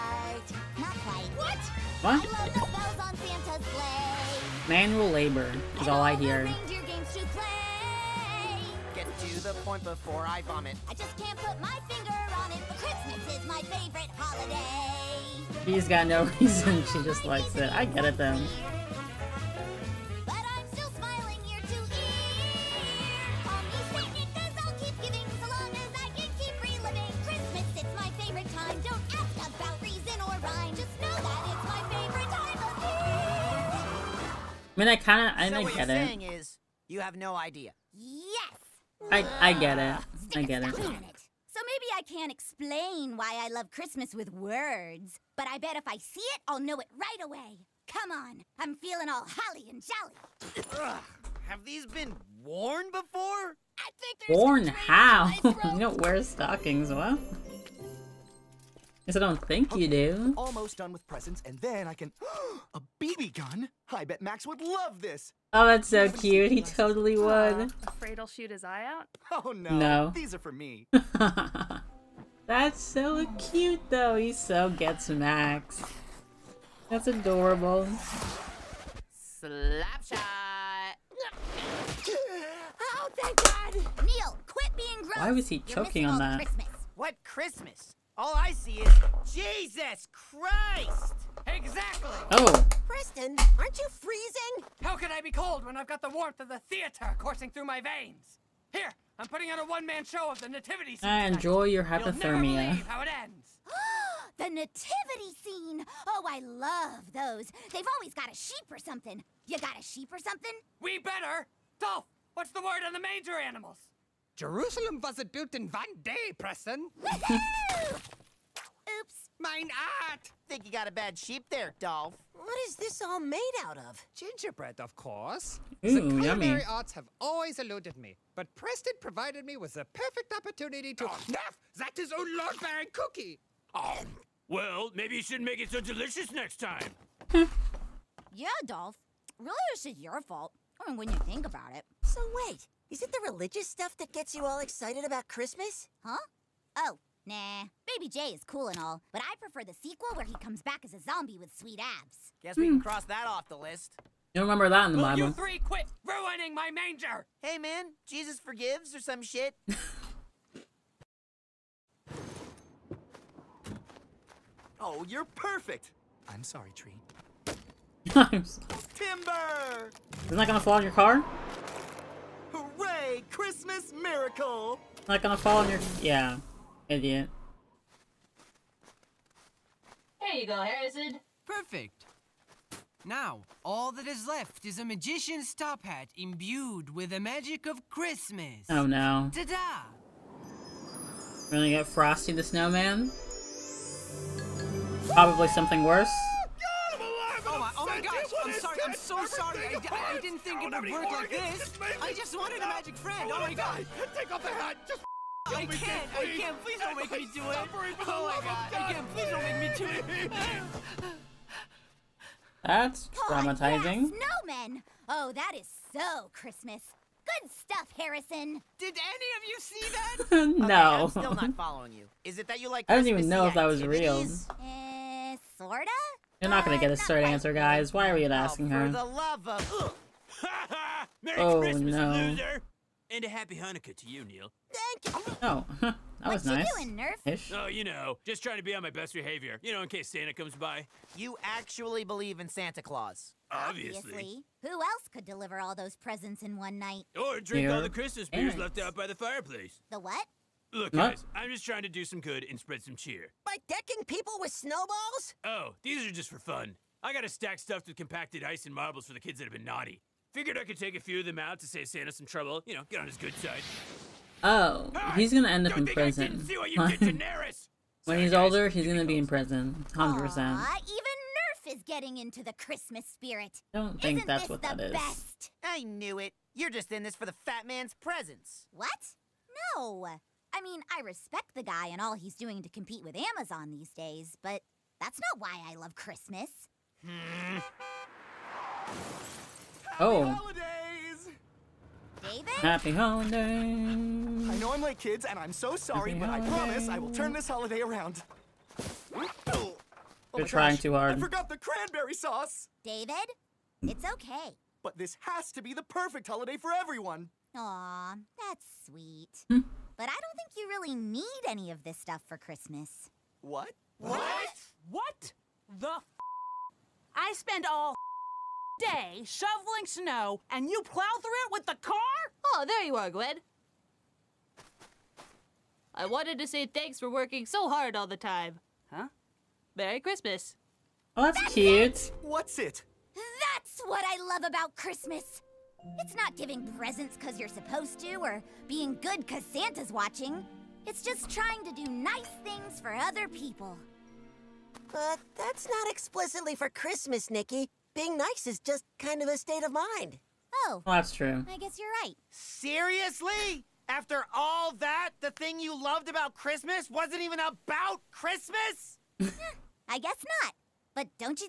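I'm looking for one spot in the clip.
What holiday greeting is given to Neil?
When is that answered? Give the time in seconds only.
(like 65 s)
233 s.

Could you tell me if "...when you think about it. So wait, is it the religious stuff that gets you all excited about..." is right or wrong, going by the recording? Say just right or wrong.
right.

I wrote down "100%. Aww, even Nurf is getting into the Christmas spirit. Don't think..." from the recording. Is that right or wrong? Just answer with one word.
right.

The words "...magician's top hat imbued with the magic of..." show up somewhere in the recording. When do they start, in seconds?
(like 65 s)
184 s.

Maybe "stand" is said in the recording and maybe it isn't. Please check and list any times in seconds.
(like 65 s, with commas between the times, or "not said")
not said.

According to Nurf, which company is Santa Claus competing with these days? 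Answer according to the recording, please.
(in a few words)
Amazon.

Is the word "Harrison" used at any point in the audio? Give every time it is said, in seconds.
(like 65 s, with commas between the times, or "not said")
180 s, 217 s.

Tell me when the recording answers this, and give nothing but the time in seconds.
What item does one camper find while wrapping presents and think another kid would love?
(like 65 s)
62 s.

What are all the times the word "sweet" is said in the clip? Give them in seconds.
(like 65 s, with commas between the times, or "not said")
151 s, 308 s.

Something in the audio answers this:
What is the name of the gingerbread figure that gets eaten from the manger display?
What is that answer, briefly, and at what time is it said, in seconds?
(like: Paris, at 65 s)
Lord Baron Cookie, at 132 s.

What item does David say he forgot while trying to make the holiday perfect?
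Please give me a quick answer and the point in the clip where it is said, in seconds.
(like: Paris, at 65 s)
Cranberry sauce, at 301 s.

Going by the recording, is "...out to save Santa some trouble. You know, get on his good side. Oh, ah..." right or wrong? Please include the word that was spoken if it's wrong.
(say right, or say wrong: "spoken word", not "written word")
right.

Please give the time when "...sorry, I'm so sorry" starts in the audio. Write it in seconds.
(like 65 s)
198 s.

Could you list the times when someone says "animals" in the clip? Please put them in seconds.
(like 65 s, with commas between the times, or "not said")
113 s.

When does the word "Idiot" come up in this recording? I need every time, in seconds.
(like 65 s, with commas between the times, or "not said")
176 s.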